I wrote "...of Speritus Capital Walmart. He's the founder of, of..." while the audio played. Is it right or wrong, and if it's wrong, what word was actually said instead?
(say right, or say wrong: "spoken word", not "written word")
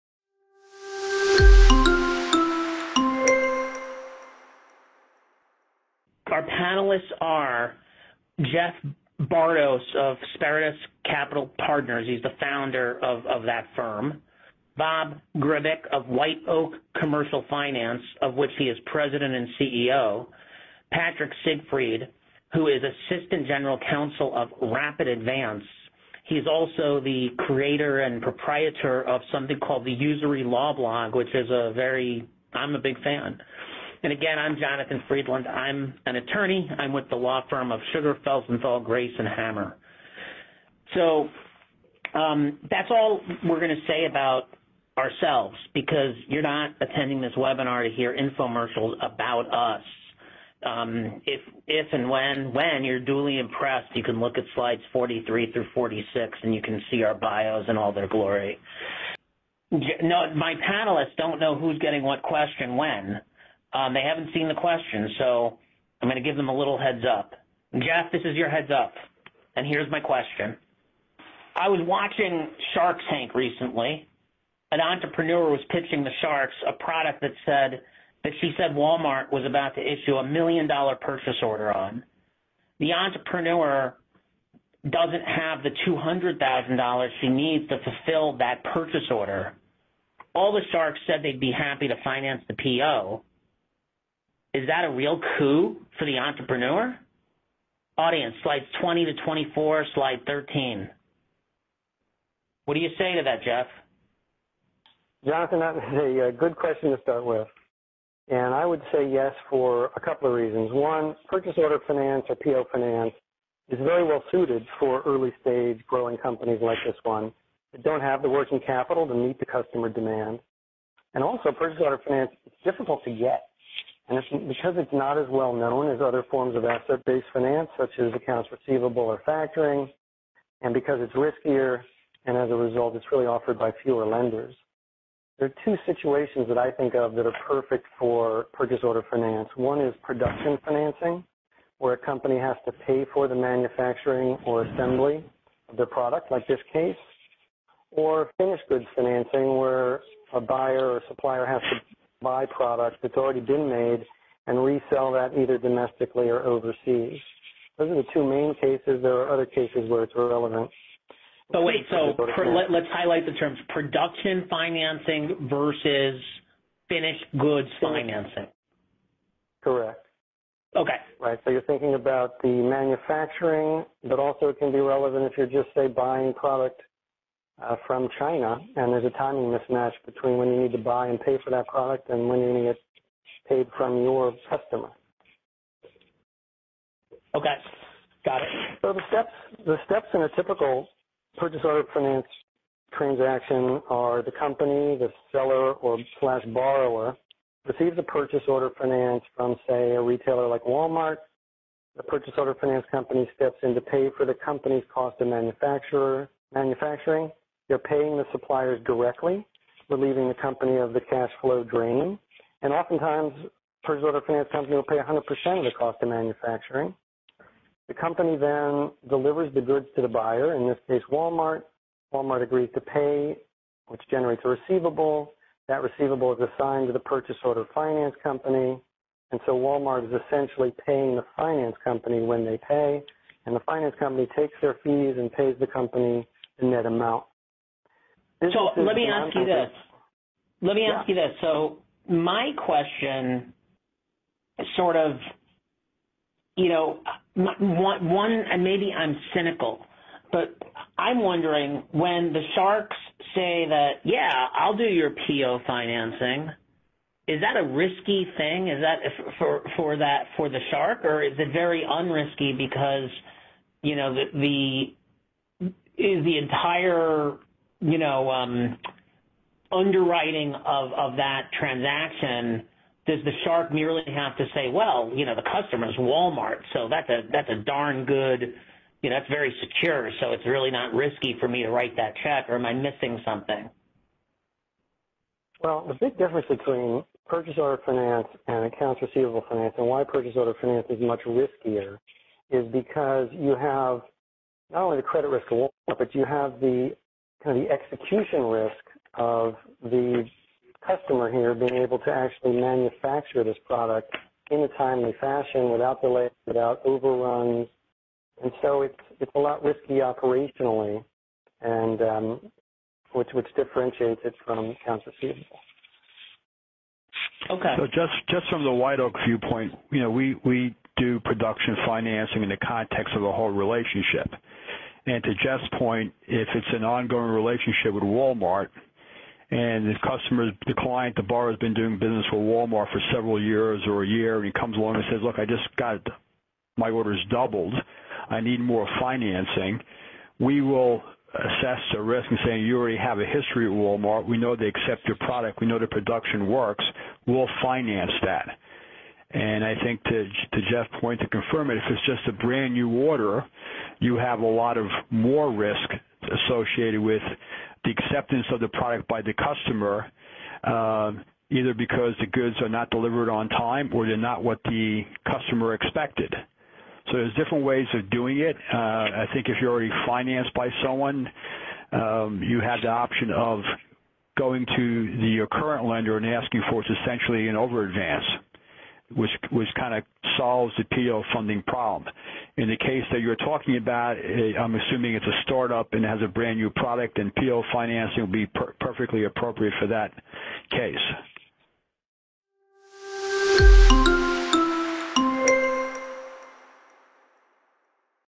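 wrong: "Partners", not "Walmart".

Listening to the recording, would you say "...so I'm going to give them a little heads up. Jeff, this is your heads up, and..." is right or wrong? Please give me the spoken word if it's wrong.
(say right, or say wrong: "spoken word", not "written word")
right.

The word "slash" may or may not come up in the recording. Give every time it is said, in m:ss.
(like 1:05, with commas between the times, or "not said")
3:16.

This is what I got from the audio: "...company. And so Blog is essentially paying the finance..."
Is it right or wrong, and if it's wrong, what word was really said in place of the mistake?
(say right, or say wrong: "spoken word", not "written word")
wrong: "Walmart", not "Blog".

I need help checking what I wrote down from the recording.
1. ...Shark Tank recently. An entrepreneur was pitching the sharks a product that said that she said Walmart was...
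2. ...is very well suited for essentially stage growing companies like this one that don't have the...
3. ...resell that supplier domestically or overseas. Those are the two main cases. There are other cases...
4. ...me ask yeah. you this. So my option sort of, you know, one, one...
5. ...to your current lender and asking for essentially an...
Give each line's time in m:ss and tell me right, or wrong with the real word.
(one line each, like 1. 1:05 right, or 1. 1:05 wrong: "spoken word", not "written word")
1. 1:12 right
2. 1:53 wrong: "early", not "essentially"
3. 2:34 wrong: "either", not "supplier"
4. 4:00 wrong: "question", not "option"
5. 6:14 right.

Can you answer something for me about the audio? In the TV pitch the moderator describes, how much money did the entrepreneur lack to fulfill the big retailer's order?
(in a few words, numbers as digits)
$200,000.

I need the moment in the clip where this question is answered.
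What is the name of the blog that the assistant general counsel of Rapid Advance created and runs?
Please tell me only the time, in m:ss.
0:29.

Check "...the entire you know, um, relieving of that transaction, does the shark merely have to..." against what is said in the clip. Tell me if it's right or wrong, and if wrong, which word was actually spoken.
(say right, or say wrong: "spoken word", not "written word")
wrong: "underwriting", not "relieving".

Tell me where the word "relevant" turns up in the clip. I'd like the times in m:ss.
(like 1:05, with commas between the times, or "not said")
2:40, 2:54.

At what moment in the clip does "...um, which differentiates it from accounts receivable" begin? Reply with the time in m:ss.
5:12.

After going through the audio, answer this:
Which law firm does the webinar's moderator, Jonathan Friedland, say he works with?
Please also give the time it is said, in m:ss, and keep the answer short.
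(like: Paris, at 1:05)
Sugar, Felsenthal, Grais, and Hammer, at 0:37.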